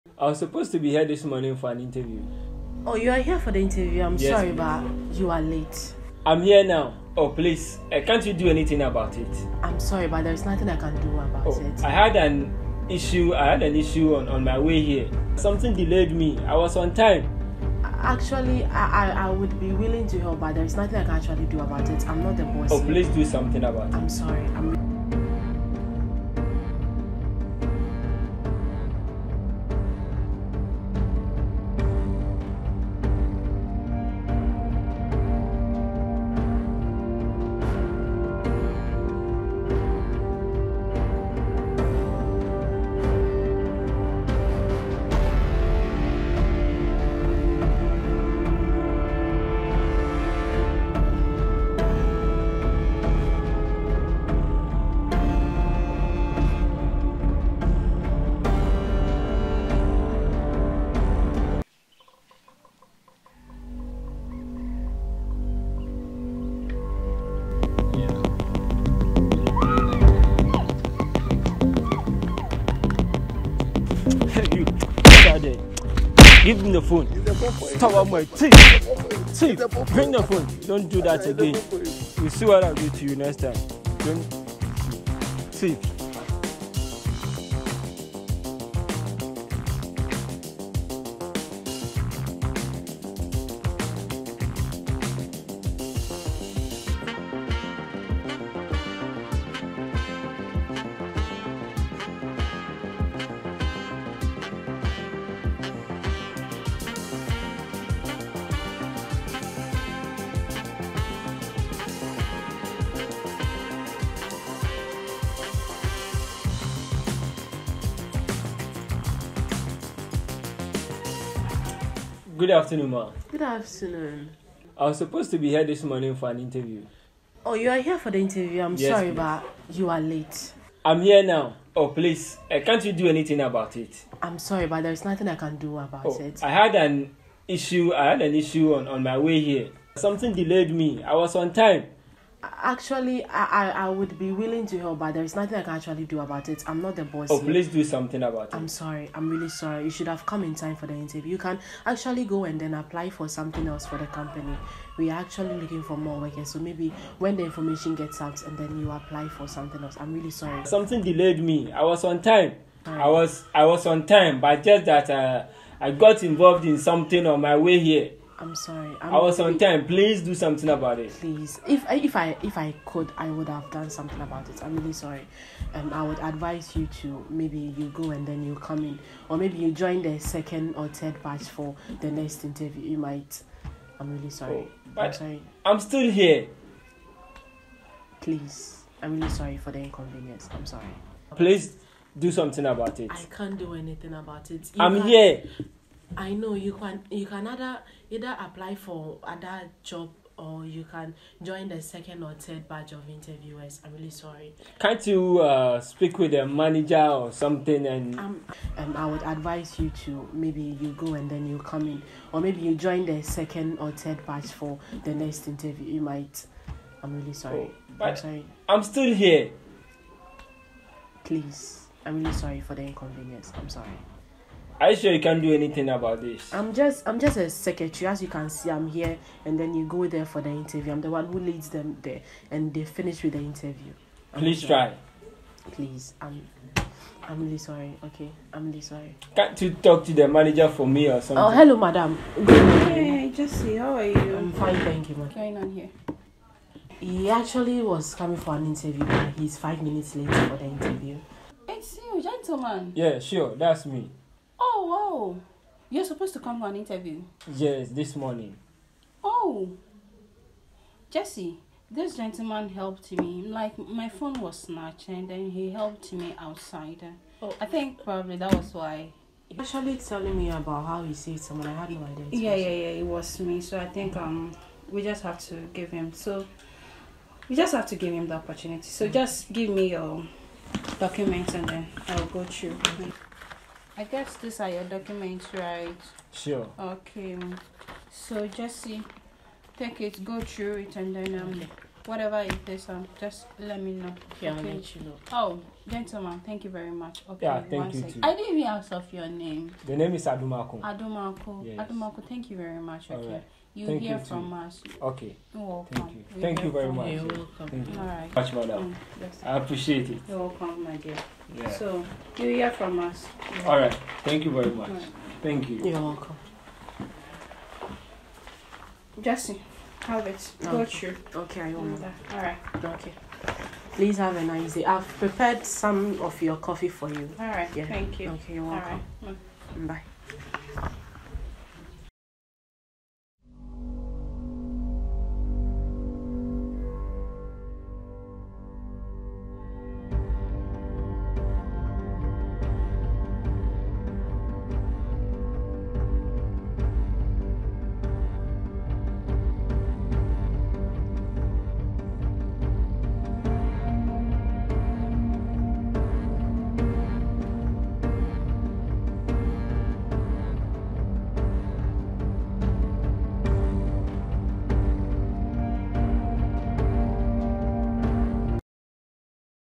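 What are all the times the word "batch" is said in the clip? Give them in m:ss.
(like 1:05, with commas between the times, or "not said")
3:01, 3:22, 3:34.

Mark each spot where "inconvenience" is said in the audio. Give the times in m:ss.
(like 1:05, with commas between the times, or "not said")
3:09, 3:42.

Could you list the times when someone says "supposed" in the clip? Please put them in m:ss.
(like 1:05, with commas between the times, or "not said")
0:00, 2:04, 4:16.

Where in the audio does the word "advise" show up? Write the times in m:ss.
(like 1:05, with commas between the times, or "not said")
2:56, 3:29.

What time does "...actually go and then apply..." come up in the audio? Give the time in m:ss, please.
2:31.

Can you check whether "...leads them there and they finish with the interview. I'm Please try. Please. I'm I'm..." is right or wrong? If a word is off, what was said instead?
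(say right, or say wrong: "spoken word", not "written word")
right.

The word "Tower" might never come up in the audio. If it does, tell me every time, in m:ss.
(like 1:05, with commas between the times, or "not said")
1:17.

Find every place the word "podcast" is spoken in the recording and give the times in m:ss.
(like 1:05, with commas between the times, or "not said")
not said.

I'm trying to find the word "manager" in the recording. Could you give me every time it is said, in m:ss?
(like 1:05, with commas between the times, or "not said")
3:26, 4:00.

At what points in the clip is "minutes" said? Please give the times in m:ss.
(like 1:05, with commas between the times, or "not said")
4:09.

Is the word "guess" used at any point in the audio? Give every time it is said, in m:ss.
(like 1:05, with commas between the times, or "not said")
4:44.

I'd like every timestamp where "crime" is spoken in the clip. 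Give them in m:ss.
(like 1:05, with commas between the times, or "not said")
not said.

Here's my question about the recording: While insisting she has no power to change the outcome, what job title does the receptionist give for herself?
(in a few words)
Secretary.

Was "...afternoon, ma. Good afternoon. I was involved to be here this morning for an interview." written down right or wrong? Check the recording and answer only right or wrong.
wrong.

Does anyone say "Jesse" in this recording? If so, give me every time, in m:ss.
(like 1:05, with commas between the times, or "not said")
4:03, 4:21, 5:19.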